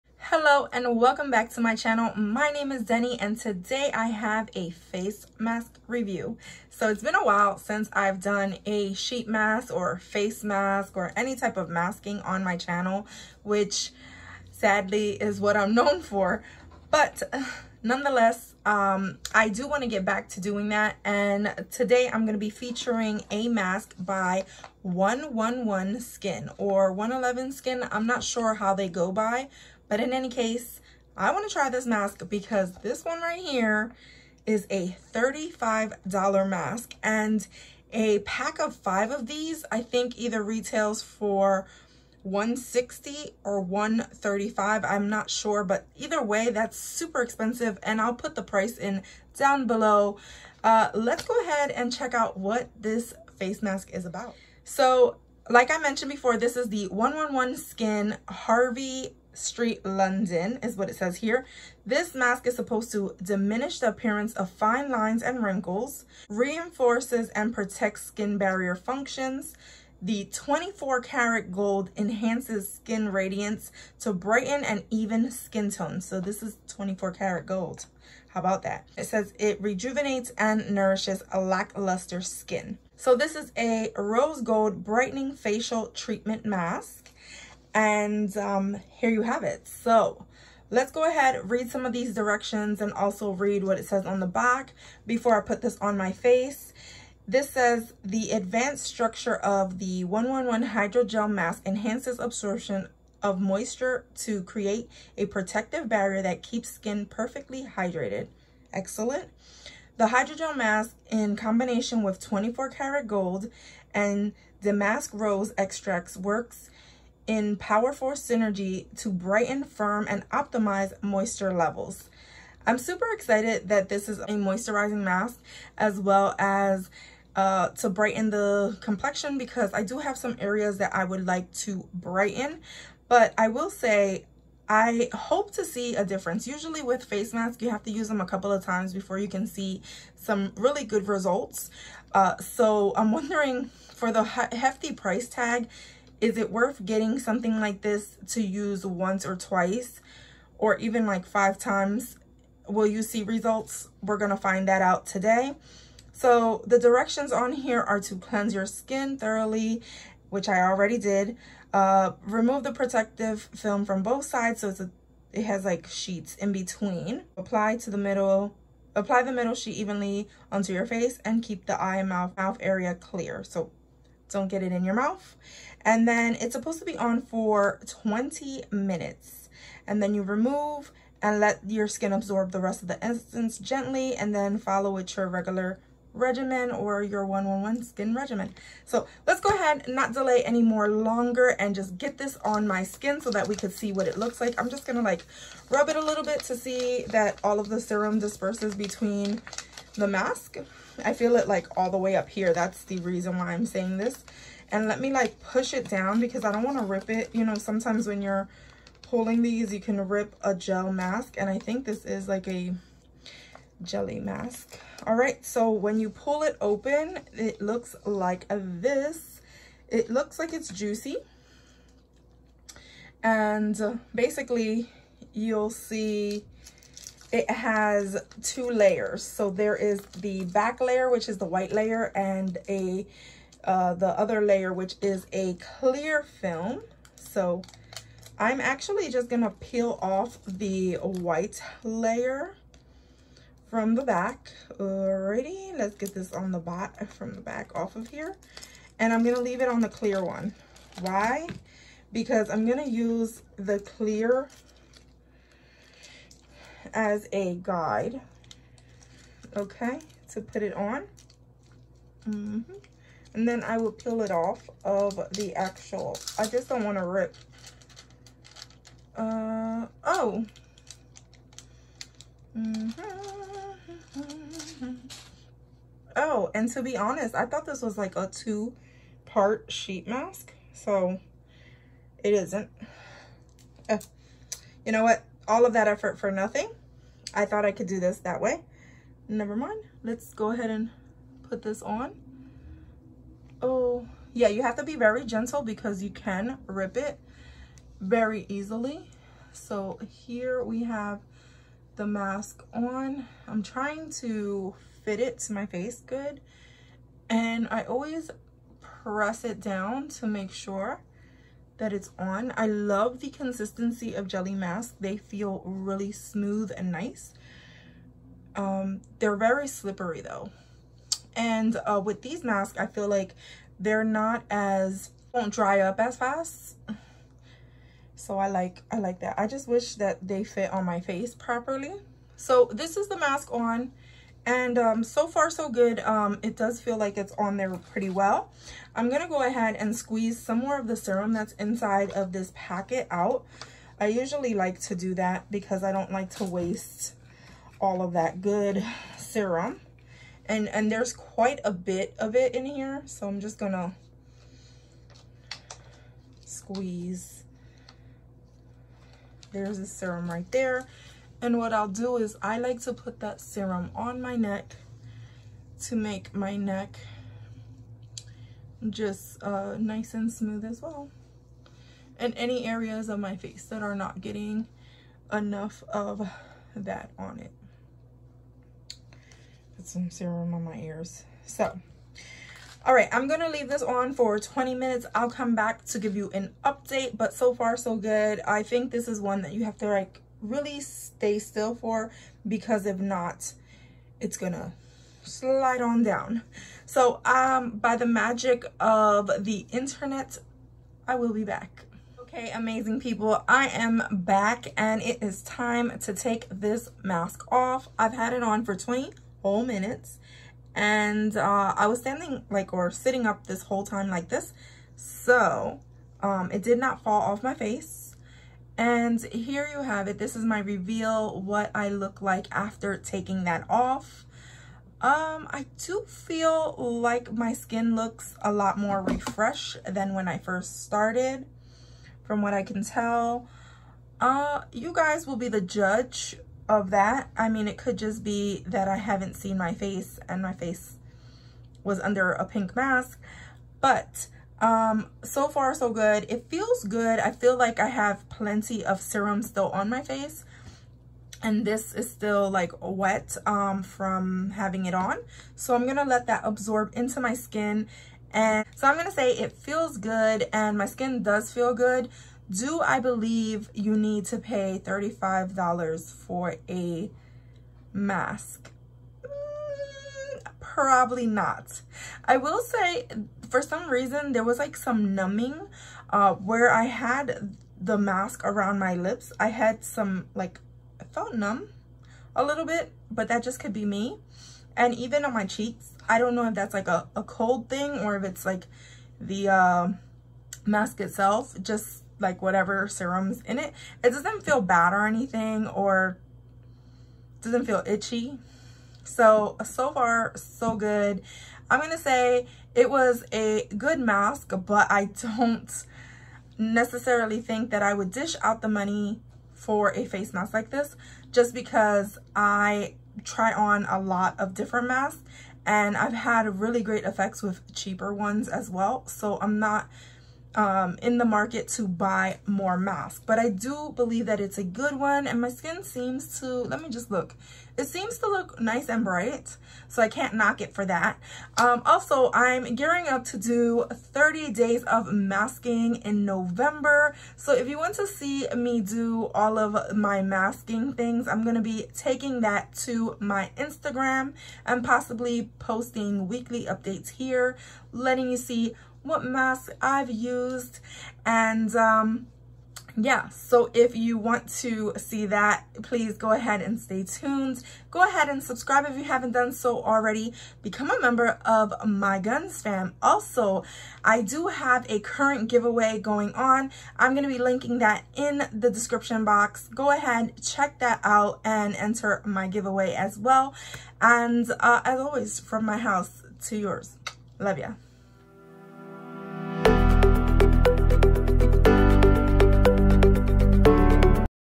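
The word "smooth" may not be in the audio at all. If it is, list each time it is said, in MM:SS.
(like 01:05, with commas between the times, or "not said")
05:16, 06:10.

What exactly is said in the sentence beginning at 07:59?
I had some like, I felt numb a little bit, but that just could be me.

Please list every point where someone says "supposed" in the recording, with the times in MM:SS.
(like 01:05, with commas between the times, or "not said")
01:02, 02:56.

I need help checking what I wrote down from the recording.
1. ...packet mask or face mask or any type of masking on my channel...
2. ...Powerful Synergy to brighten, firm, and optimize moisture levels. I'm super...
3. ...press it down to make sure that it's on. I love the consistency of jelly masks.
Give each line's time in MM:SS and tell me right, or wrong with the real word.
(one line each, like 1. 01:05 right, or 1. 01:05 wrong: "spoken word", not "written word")
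1. 00:08 wrong: "sheet", not "packet"
2. 01:57 right
3. 05:08 right.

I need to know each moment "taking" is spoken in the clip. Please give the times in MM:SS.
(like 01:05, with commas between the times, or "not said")
07:02, 09:01.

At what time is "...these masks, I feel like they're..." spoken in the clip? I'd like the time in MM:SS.
05:22.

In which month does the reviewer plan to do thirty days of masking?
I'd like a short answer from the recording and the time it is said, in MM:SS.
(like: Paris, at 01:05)
November, at 08:56.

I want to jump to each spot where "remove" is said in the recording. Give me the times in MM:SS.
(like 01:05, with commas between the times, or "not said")
02:42, 03:00.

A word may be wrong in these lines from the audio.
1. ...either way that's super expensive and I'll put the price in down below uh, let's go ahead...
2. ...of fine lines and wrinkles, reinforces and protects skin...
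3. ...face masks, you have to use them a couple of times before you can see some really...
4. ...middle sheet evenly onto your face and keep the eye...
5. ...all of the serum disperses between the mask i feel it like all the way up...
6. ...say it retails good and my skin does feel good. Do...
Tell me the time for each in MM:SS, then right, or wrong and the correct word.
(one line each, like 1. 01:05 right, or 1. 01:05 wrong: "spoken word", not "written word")
1. 00:45 right
2. 01:04 right
3. 02:17 right
4. 02:49 right
5. 03:17 right
6. 07:39 wrong: "feels", not "retails".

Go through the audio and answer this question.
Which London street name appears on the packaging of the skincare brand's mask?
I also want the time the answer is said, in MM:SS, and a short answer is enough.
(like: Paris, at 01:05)
Harley Street, at 00:58.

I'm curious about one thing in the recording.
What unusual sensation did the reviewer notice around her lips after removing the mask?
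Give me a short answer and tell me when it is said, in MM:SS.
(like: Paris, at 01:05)
numbing, at 07:55.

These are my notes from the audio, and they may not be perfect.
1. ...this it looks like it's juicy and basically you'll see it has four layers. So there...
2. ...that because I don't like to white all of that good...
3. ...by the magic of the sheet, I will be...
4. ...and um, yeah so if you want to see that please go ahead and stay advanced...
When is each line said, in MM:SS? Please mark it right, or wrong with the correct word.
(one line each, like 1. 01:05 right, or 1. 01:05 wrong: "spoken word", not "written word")
1. 03:38 wrong: "two", not "four"
2. 05:45 wrong: "waste", not "white"
3. 06:37 wrong: "internet", not "sheet"
4. 09:11 wrong: "tuned", not "advanced".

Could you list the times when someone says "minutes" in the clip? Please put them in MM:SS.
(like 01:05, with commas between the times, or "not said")
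02:58, 06:24, 06:49.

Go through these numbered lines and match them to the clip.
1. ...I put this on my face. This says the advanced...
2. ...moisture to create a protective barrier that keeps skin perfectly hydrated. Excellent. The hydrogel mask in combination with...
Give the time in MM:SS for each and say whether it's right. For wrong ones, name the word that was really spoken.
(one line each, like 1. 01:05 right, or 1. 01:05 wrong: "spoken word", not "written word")
1. 01:35 right
2. 01:43 right.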